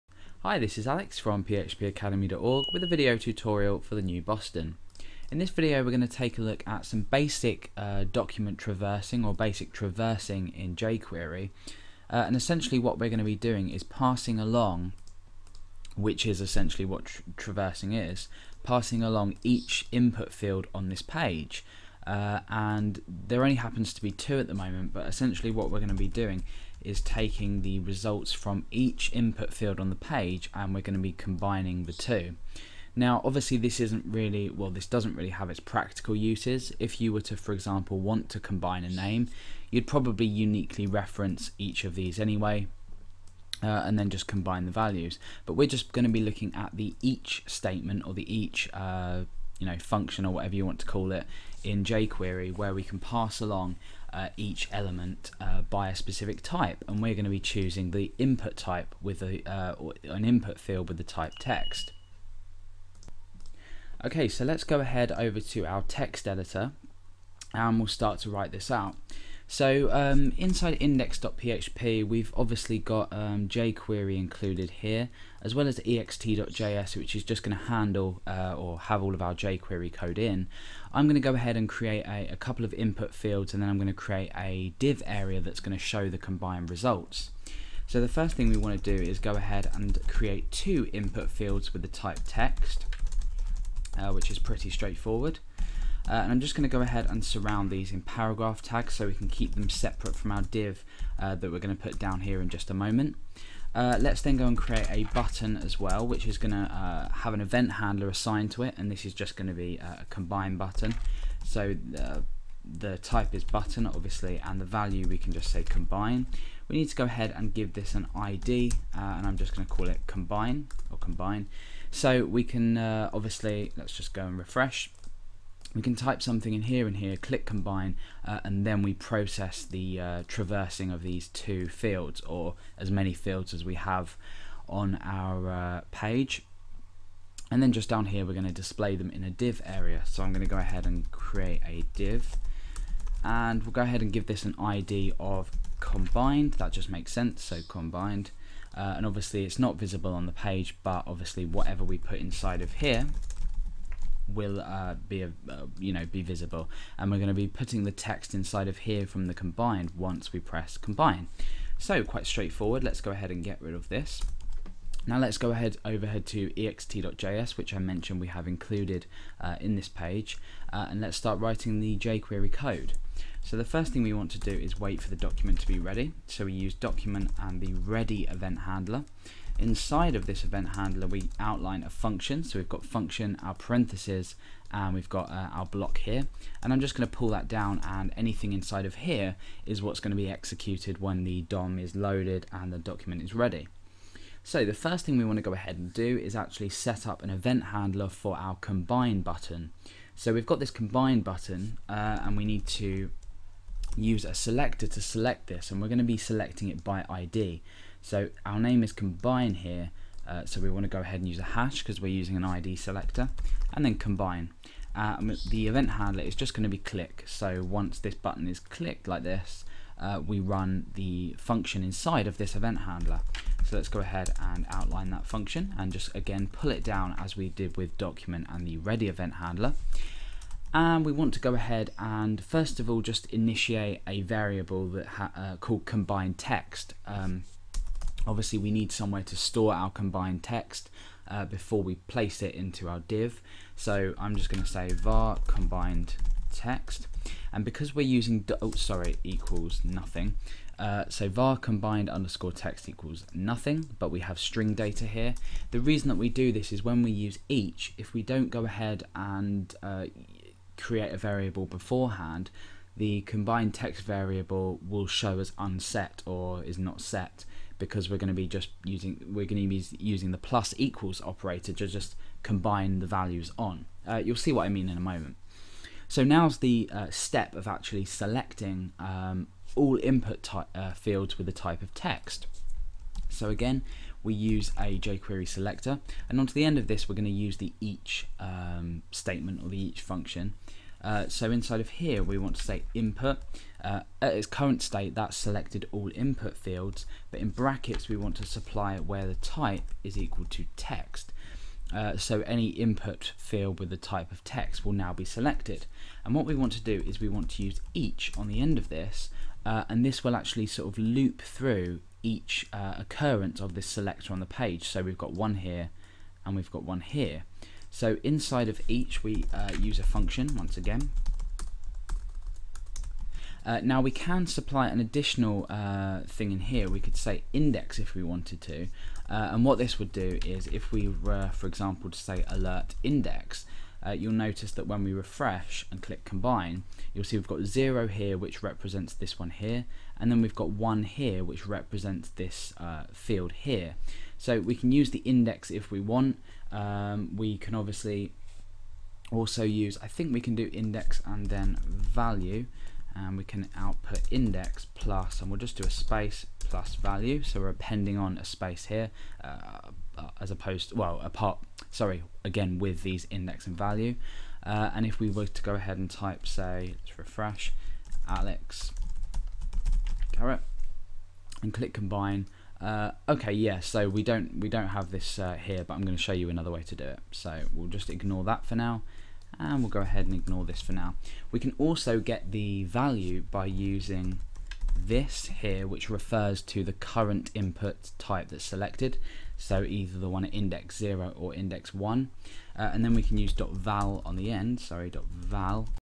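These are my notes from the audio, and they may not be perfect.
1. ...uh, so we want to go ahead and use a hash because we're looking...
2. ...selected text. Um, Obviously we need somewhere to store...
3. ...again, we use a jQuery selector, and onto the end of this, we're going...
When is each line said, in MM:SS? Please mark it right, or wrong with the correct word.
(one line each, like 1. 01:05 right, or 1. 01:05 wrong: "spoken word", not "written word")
1. 03:30 wrong: "using", not "looking"
2. 03:55 wrong: "combined", not "selected"
3. 04:43 right.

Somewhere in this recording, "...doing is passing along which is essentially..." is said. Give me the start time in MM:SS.
00:13.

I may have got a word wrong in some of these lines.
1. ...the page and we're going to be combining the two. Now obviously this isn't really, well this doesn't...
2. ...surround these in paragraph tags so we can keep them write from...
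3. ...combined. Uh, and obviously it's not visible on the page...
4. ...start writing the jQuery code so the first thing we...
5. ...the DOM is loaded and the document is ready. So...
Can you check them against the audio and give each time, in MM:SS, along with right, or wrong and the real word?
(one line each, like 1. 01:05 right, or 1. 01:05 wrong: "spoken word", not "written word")
1. 00:29 right
2. 01:37 wrong: "separate", not "write"
3. 02:27 right
4. 02:51 right
5. 03:11 right.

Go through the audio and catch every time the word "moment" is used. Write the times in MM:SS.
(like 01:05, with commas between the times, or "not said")
00:24, 01:42, 04:35.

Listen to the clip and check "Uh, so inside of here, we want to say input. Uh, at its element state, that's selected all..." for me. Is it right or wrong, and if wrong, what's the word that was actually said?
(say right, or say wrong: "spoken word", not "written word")
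wrong: "current", not "element".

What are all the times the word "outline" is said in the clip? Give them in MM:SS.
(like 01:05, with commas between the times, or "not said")
03:01, 03:44.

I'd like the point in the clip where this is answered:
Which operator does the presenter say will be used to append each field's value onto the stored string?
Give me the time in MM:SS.
04:30.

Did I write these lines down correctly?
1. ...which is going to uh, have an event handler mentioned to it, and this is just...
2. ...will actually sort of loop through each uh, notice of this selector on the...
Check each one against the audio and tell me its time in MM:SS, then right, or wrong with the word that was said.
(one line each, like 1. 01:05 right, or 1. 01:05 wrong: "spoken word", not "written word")
1. 01:46 wrong: "assigned", not "mentioned"
2. 05:10 wrong: "occurrence", not "notice".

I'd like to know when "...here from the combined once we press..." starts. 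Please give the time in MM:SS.
02:38.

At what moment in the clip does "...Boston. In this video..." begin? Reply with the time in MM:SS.
00:04.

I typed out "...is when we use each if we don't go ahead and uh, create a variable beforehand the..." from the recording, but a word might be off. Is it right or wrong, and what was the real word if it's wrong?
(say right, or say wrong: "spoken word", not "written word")
right.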